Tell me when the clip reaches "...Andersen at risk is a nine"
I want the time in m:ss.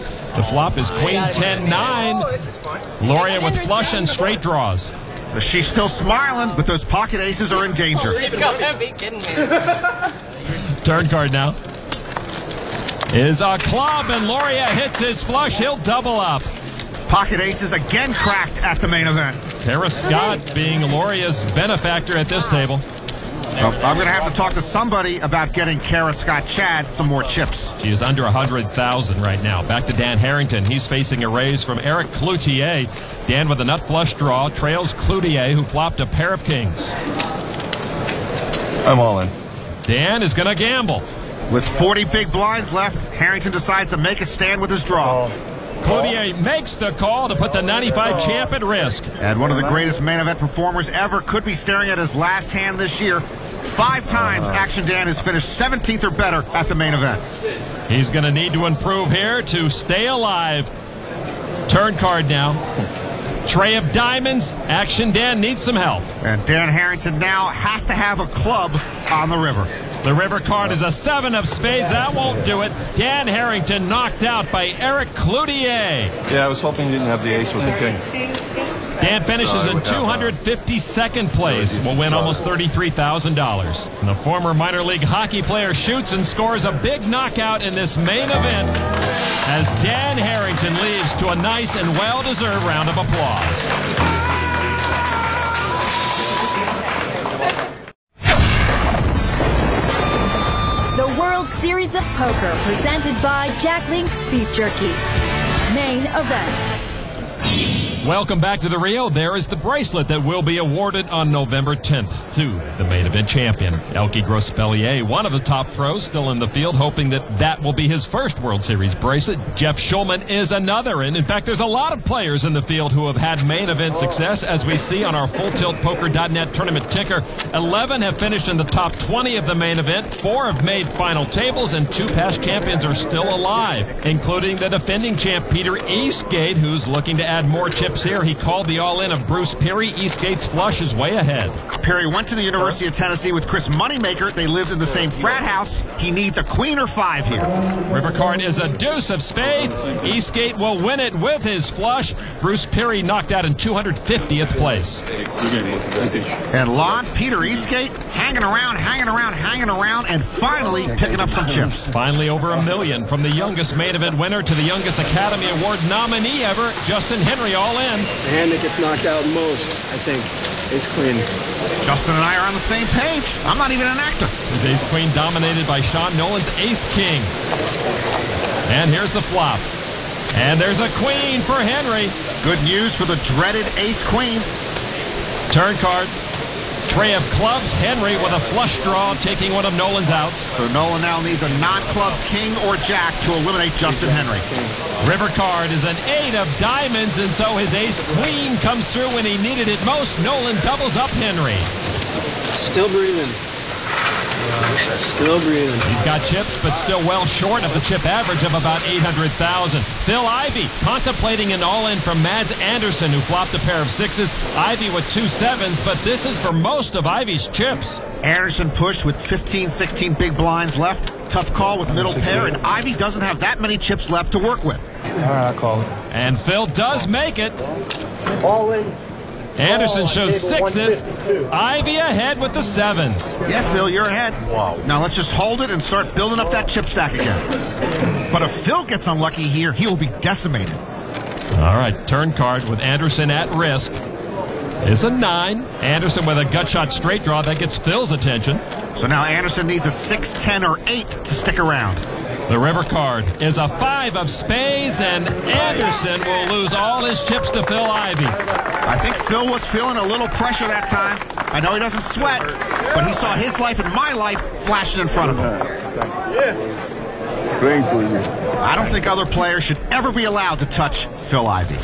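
4:02.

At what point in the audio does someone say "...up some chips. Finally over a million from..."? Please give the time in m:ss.
2:41.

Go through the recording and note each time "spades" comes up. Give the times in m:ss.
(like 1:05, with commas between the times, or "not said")
1:11, 2:29, 4:14.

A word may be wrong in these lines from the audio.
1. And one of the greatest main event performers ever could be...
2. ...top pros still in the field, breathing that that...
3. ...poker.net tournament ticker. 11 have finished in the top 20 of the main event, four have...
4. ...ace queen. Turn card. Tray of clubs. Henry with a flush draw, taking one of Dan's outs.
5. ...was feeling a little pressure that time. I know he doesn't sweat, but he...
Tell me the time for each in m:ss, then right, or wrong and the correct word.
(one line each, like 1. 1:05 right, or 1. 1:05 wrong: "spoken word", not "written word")
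1. 0:49 right
2. 1:55 wrong: "hoping", not "breathing"
3. 2:05 right
4. 3:03 wrong: "Nolan", not "Dan"
5. 4:19 right.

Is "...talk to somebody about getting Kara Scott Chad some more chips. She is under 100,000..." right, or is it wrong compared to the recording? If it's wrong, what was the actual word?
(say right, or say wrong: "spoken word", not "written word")
right.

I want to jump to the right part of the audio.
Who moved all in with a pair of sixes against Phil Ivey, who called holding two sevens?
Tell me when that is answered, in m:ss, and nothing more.
3:32.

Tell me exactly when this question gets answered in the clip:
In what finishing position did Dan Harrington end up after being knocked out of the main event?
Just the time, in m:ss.
1:19.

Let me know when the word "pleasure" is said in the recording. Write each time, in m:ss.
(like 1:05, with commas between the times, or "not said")
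not said.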